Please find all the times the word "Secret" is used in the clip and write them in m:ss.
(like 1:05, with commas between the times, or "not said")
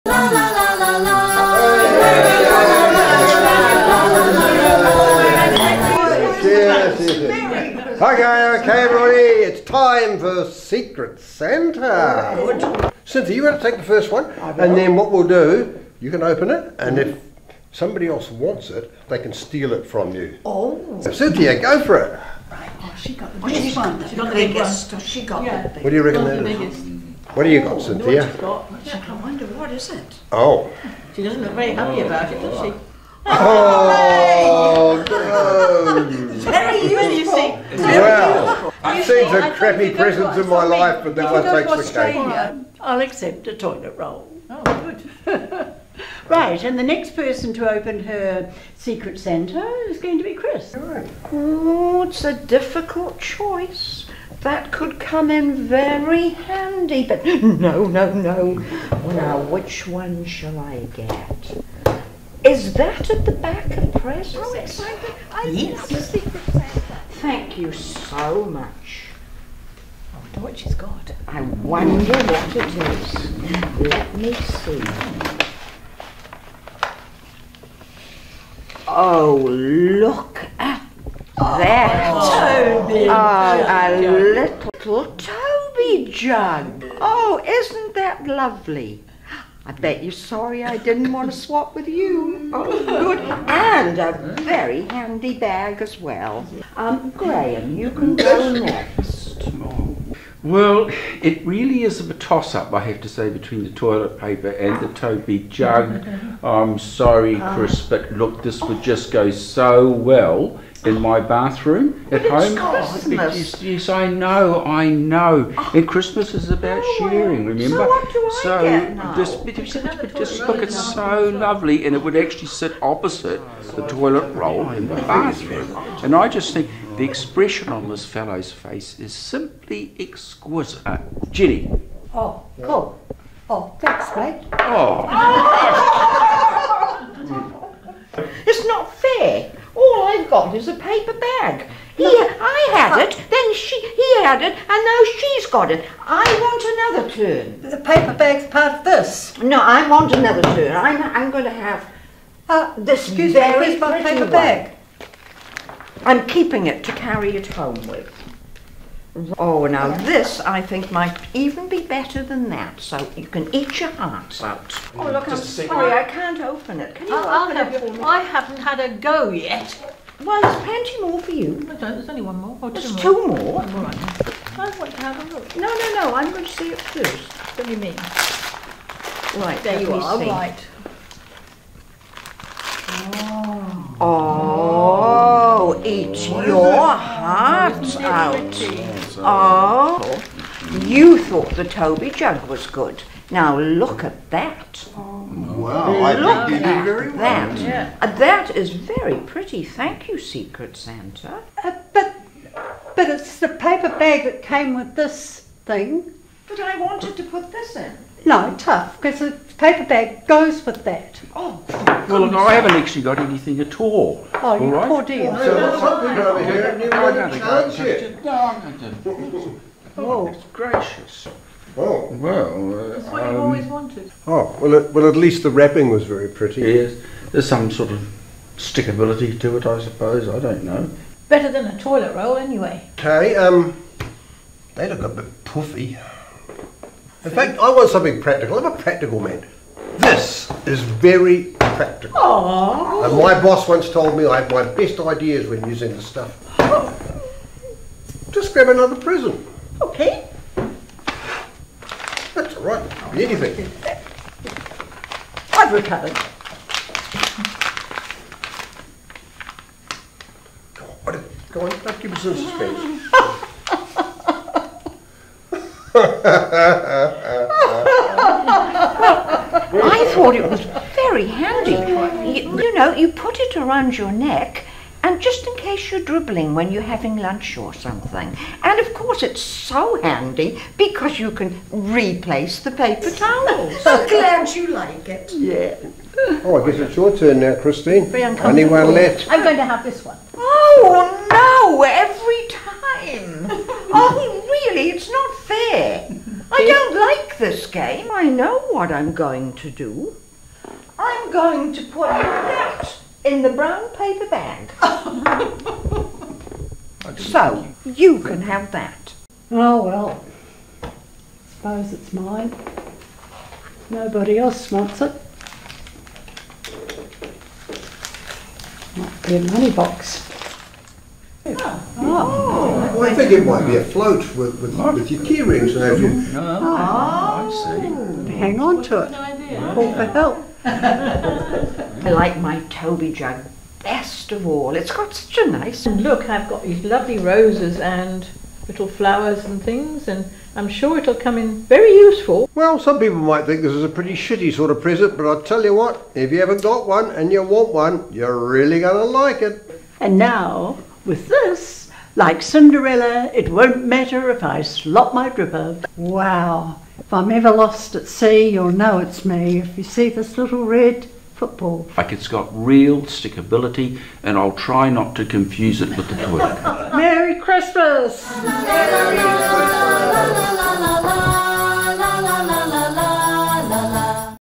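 0:10, 0:48, 1:06, 3:20.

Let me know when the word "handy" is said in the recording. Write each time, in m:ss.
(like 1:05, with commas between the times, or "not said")
0:56, 1:34, 4:31, 4:40.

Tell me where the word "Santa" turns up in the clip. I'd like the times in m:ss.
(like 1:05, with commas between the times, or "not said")
0:11, 0:49, 1:06, 3:20.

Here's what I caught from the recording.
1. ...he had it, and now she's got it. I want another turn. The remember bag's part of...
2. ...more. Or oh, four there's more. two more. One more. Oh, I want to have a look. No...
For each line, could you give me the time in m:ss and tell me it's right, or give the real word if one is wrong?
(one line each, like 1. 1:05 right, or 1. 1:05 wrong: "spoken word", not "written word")
1. 2:23 wrong: "paper", not "remember"
2. 2:52 wrong: "two", not "four".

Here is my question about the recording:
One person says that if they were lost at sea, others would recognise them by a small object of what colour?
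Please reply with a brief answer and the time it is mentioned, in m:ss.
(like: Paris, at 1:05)
Red, at 6:00.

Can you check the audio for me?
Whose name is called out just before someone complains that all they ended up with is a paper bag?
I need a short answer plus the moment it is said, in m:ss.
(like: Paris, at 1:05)
Jenny, at 2:11.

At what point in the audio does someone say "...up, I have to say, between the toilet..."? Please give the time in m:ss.
1:42.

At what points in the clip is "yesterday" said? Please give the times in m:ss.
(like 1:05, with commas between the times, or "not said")
not said.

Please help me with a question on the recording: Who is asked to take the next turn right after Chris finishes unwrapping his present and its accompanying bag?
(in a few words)
Graham.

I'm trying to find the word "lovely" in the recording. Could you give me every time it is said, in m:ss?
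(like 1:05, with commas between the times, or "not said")
1:28, 2:01, 5:36.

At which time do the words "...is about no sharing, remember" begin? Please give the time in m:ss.
1:56.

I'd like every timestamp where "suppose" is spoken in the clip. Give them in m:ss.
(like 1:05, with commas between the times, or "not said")
3:49, 5:11.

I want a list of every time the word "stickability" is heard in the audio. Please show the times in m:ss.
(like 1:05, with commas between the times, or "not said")
3:48, 6:03.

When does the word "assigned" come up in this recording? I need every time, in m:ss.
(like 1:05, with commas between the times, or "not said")
not said.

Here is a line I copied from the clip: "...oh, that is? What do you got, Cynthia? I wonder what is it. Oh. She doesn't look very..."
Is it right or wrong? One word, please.
right.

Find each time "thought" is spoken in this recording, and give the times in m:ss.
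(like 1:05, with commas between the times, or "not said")
3:11, 4:30.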